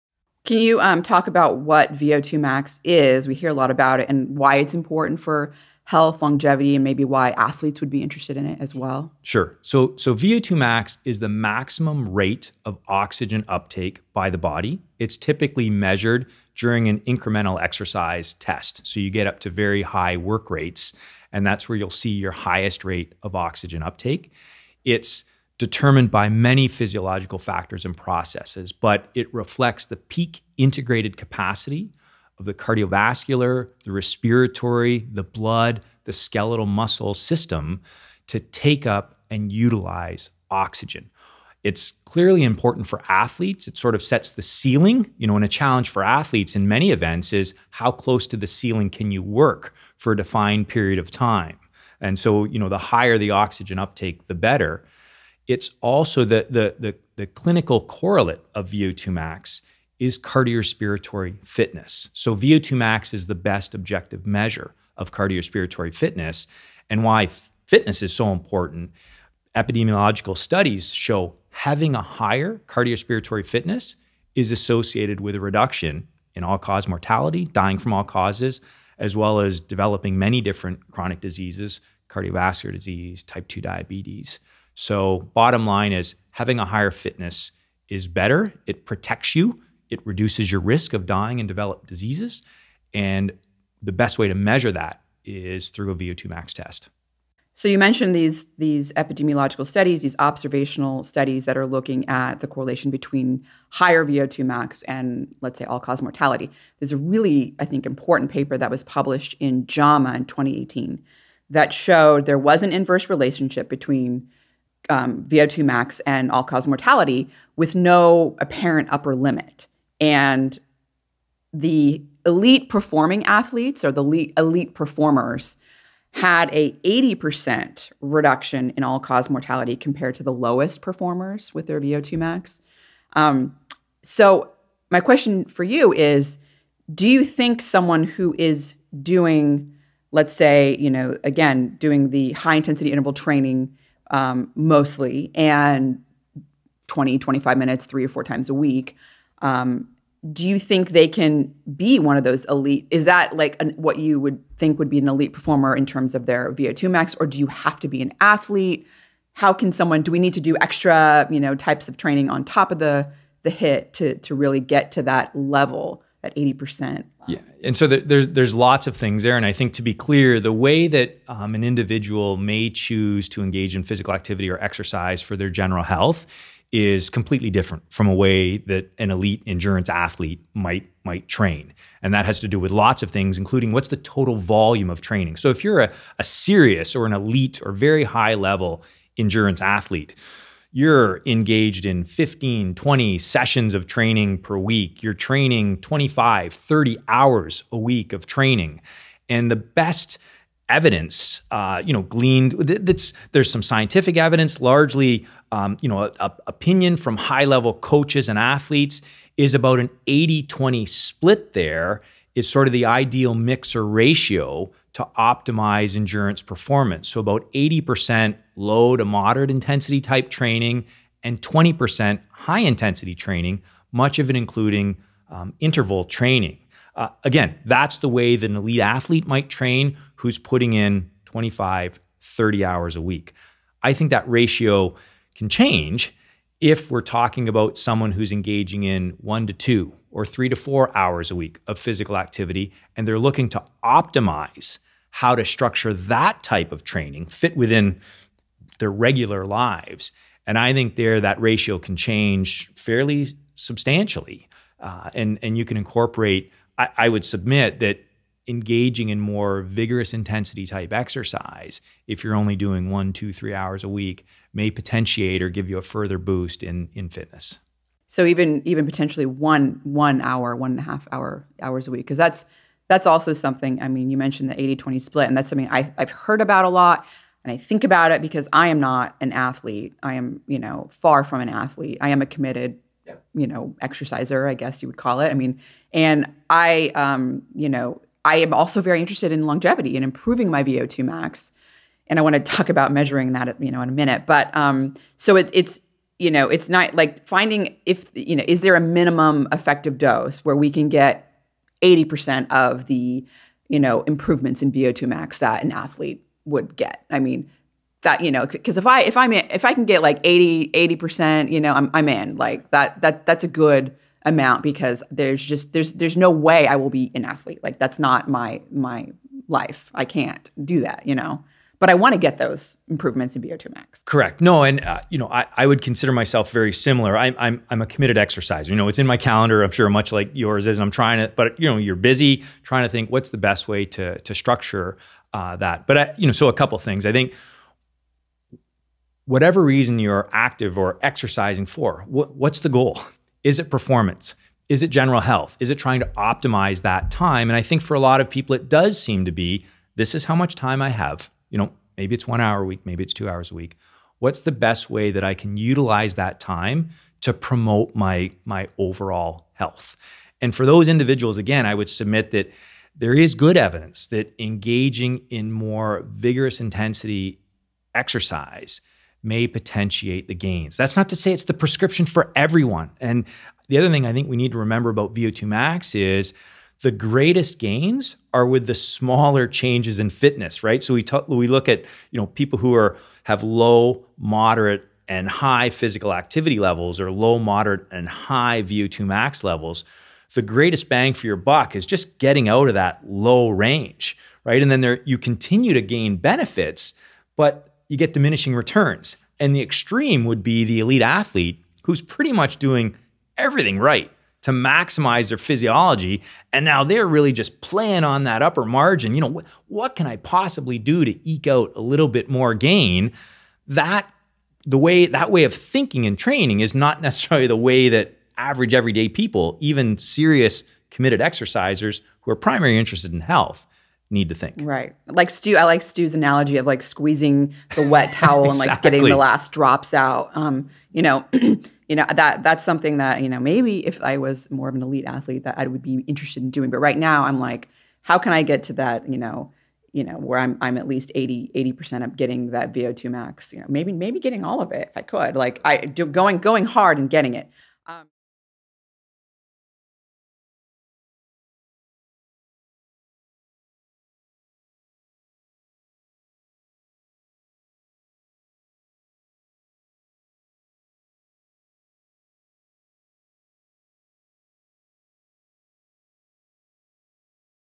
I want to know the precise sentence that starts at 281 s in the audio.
I am a committed, you know, exerciser, I guess you would call it.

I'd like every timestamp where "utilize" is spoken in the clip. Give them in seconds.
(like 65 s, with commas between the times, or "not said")
39 s, 355 s.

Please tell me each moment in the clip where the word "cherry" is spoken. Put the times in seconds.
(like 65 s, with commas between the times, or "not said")
not said.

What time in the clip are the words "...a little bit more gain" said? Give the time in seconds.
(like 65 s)
411 s.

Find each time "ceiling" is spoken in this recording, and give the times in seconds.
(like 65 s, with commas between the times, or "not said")
44 s, 48 s.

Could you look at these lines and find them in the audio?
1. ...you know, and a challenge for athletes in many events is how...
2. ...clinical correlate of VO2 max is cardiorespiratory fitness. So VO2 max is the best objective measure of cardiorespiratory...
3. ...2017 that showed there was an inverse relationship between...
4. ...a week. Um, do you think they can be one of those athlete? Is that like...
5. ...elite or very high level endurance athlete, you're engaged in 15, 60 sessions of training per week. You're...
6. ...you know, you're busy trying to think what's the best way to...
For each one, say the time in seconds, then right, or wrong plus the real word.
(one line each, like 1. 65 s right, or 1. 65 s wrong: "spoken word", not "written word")
1. 45 s right
2. 57 s right
3. 110 s wrong: "2018", not "2017"
4. 148 s wrong: "elite", not "athlete"
5. 187 s wrong: "20", not "60"
6. 331 s right.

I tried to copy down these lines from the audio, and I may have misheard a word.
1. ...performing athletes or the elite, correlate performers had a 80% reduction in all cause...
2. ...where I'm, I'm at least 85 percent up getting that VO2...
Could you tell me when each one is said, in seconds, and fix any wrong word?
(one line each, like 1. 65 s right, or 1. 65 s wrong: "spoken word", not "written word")
1. 122 s wrong: "elite", not "correlate"
2. 440 s wrong: "80", not "85".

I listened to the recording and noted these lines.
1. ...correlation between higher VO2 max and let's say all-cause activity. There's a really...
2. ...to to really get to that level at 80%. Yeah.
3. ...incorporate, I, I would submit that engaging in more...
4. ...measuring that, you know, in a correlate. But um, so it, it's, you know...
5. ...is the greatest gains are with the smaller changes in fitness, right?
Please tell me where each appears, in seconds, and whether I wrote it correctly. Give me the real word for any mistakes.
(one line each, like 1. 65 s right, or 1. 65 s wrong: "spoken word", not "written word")
1. 102 s wrong: "mortality", not "activity"
2. 163 s right
3. 255 s right
4. 292 s wrong: "minute", not "correlate"
5. 375 s right.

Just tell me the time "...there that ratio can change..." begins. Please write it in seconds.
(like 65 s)
250 s.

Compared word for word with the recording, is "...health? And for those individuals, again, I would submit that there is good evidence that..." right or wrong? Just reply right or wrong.
right.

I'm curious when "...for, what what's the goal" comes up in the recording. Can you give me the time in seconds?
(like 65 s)
341 s.